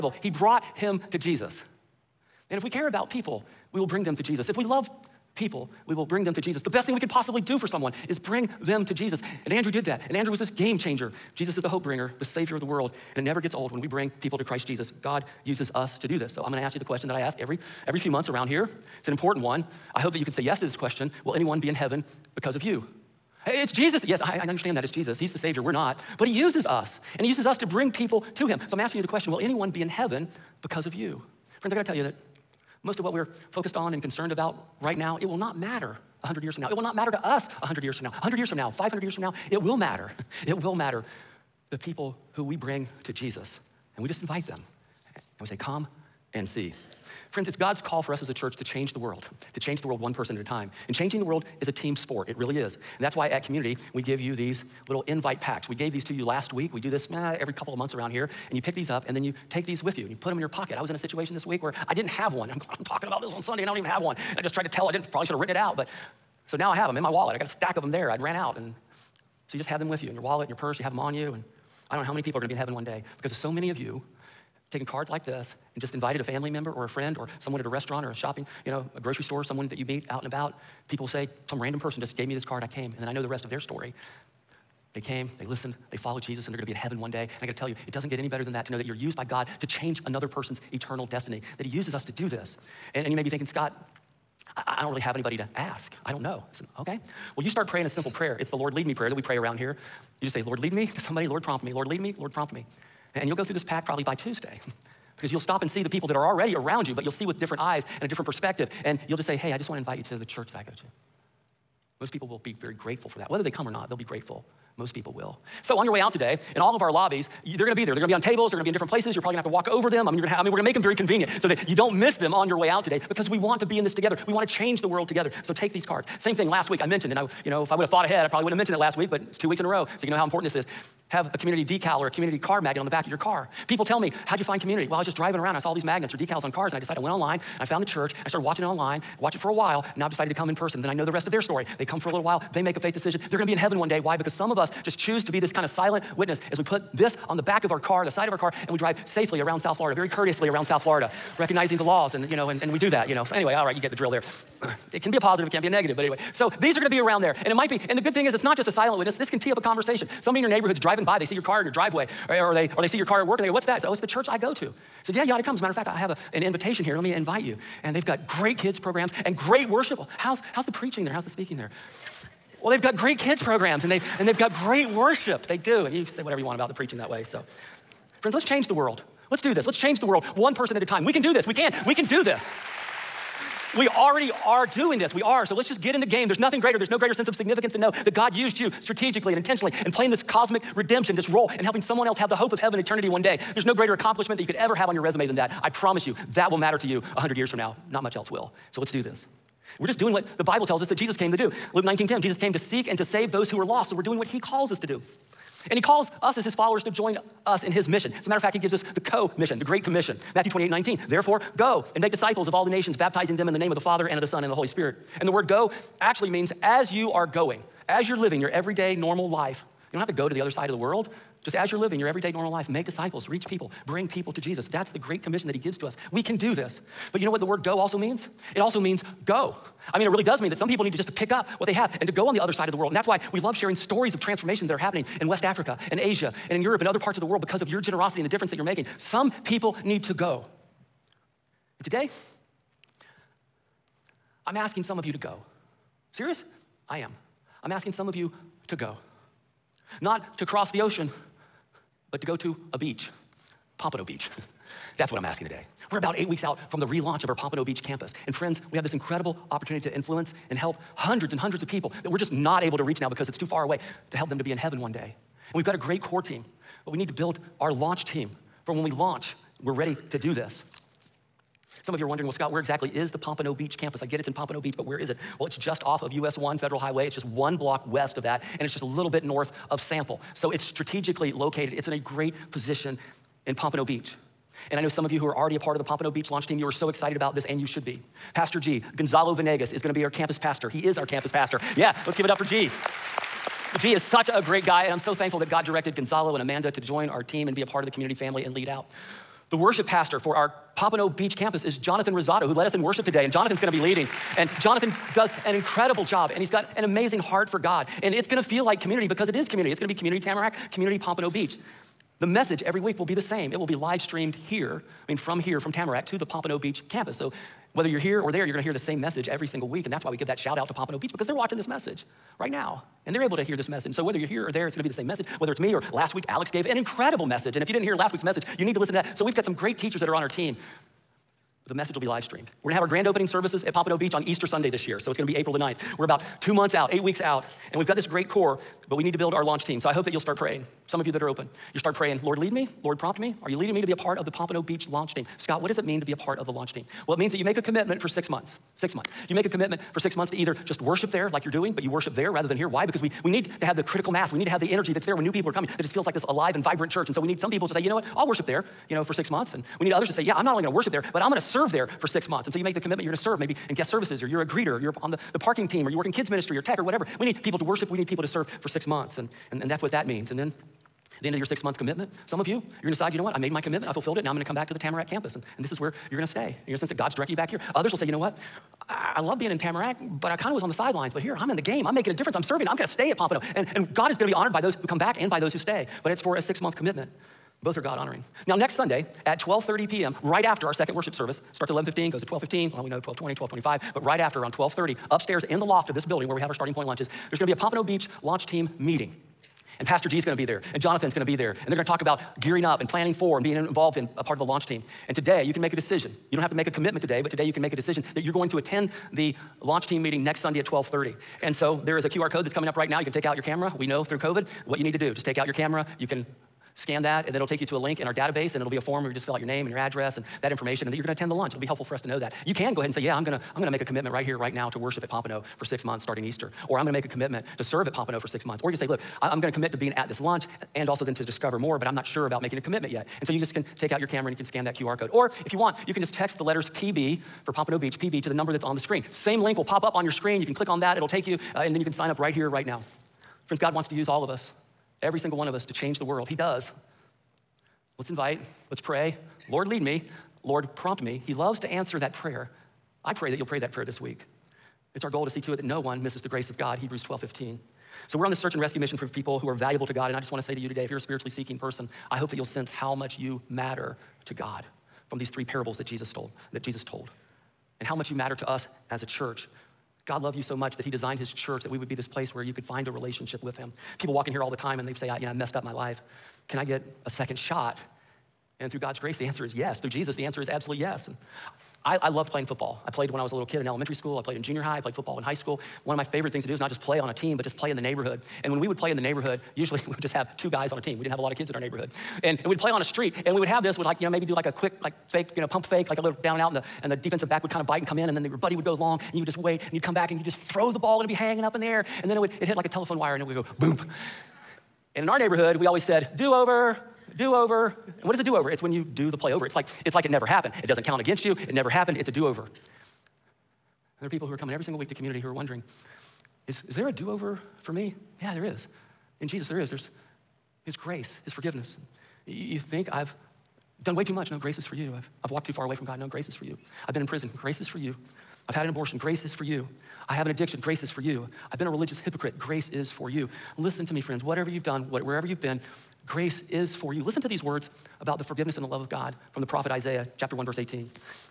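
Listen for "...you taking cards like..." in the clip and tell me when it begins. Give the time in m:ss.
1:13.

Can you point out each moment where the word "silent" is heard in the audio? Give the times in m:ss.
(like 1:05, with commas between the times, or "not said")
2:25, 2:38.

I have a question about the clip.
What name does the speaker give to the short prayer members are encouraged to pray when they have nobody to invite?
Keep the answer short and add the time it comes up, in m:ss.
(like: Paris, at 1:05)
Lord lead me prayer, at 1:38.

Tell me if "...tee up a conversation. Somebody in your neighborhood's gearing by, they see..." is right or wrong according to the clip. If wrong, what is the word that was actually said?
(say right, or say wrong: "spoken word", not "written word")
wrong: "driving", not "gearing".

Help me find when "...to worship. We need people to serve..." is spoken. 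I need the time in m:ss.
6:07.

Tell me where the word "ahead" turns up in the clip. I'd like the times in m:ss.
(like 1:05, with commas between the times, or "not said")
2:08, 7:02.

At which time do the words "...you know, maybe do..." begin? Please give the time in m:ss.
8:13.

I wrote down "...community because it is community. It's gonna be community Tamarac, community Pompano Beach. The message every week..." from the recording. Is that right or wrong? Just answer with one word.
right.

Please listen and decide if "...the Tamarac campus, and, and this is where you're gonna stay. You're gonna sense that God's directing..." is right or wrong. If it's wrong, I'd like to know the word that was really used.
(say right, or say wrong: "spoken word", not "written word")
right.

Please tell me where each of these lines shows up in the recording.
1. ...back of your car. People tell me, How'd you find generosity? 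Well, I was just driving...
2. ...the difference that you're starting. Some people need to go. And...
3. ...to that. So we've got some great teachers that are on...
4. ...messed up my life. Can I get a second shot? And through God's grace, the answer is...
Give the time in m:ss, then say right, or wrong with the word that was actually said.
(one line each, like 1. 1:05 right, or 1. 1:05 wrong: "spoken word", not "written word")
1. 2:12 wrong: "community", not "generosity"
2. 3:58 wrong: "making", not "starting"
3. 5:28 right
4. 7:55 right.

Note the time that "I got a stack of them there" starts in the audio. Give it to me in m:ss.
1:07.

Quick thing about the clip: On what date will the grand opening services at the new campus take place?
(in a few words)
April 9.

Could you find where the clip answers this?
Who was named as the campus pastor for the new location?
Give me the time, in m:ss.
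4:48.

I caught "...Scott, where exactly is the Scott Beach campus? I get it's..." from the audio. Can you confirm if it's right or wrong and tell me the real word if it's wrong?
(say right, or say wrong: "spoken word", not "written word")
wrong: "Pompano", not "Scott".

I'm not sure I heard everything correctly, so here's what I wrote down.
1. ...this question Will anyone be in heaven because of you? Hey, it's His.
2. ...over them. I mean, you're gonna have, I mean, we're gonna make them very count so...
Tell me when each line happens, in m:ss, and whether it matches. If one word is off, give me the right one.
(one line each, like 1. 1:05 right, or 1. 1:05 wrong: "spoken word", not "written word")
1. 0:20 wrong: "Jesus", not "His"
2. 1:59 wrong: "convenient", not "count".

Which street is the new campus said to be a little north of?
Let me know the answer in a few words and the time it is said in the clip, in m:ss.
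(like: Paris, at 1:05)
Sample, at 4:39.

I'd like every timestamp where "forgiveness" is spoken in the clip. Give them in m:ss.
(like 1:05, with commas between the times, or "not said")
8:41, 8:58.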